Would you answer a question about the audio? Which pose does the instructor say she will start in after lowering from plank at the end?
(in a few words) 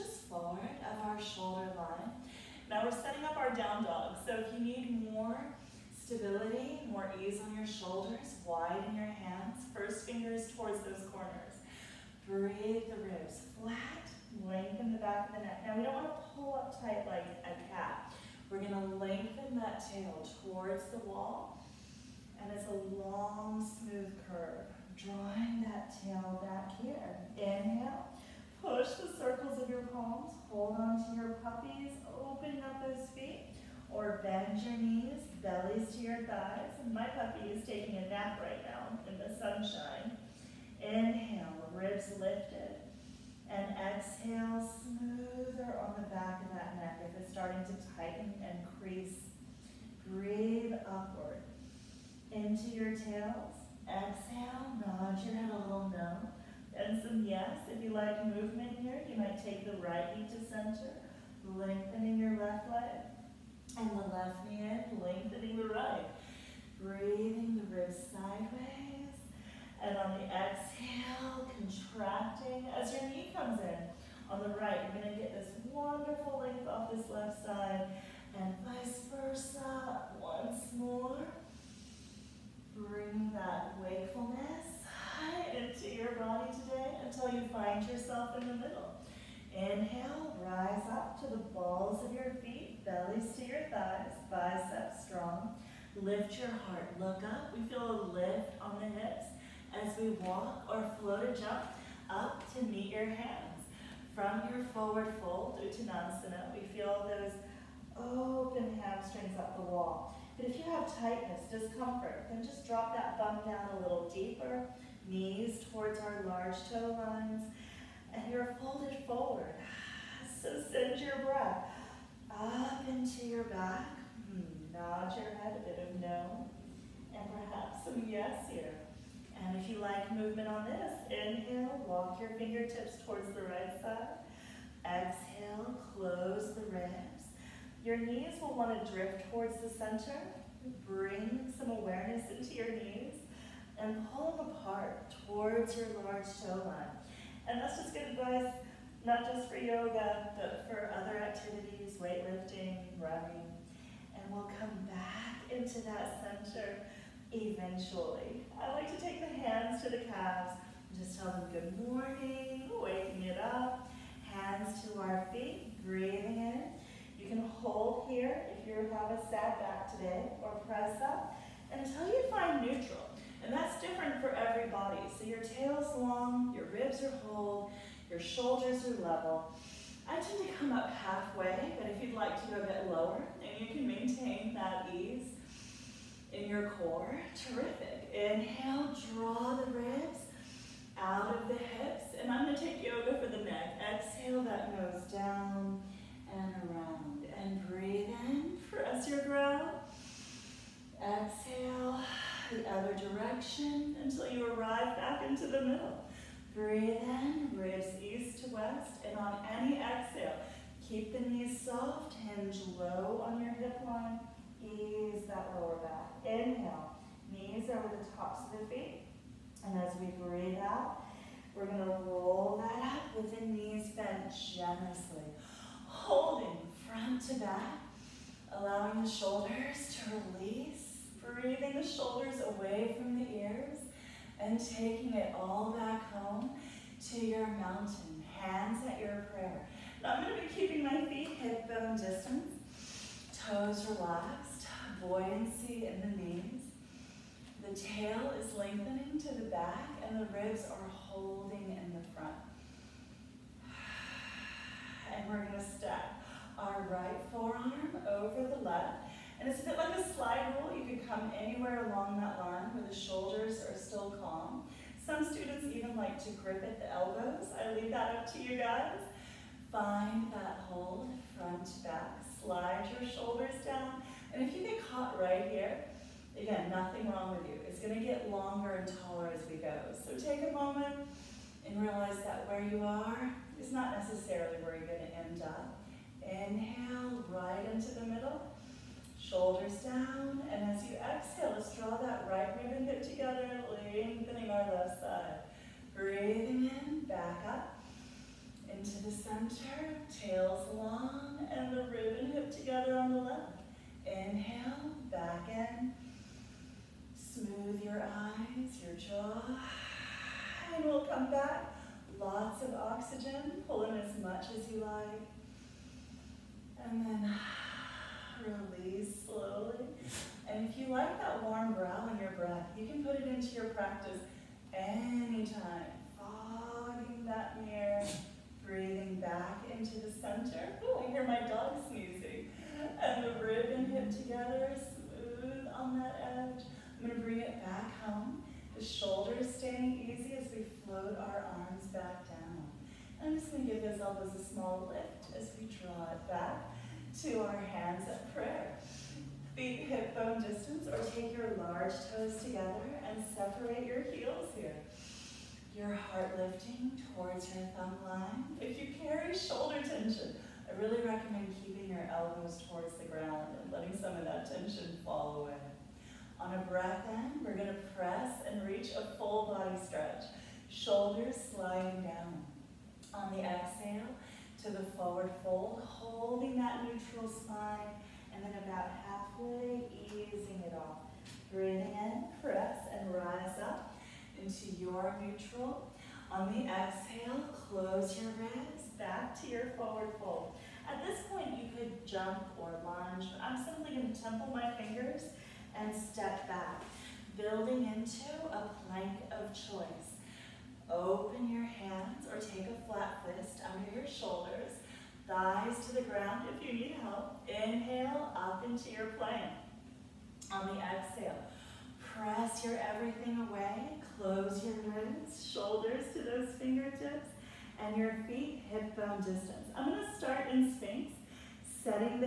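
Sphinx.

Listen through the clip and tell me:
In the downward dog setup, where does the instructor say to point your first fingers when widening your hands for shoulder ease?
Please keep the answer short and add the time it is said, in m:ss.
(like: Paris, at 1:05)
Towards those corners, at 0:10.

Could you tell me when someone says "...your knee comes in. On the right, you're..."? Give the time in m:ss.
1:12.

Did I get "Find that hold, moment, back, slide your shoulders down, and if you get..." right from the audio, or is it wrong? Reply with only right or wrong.
wrong.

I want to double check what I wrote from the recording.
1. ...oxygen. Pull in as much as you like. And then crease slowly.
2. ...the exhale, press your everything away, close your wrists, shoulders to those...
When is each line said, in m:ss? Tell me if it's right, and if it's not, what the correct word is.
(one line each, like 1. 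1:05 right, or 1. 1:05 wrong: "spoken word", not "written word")
1. 5:12 wrong: "release", not "crease"
2. 6:50 right.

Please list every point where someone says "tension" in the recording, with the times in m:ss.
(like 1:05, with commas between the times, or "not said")
5:59, 6:04.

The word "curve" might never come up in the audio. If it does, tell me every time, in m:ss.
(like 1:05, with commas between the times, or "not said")
0:24.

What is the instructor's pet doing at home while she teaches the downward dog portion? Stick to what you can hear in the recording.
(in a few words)
Taking a nap.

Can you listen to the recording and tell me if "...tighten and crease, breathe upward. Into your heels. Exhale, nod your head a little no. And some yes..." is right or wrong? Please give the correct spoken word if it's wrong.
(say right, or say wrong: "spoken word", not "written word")
wrong: "tails", not "heels".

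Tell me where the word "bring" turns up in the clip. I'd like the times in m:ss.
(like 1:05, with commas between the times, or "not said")
1:22, 2:20, 5:37.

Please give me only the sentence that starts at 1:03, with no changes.
And the left knee in, lengthening the right.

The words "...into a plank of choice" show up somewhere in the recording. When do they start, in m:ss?
6:37.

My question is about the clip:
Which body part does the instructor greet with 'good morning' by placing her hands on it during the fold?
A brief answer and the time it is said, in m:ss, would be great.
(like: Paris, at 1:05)
Calves, at 2:39.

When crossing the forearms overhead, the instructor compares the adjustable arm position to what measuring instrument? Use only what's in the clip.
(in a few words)
A slide rule.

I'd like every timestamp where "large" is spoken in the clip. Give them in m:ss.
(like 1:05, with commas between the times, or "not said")
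1:56, 2:26, 5:51.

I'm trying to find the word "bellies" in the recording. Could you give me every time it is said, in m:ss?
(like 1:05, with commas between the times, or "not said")
0:35, 1:32.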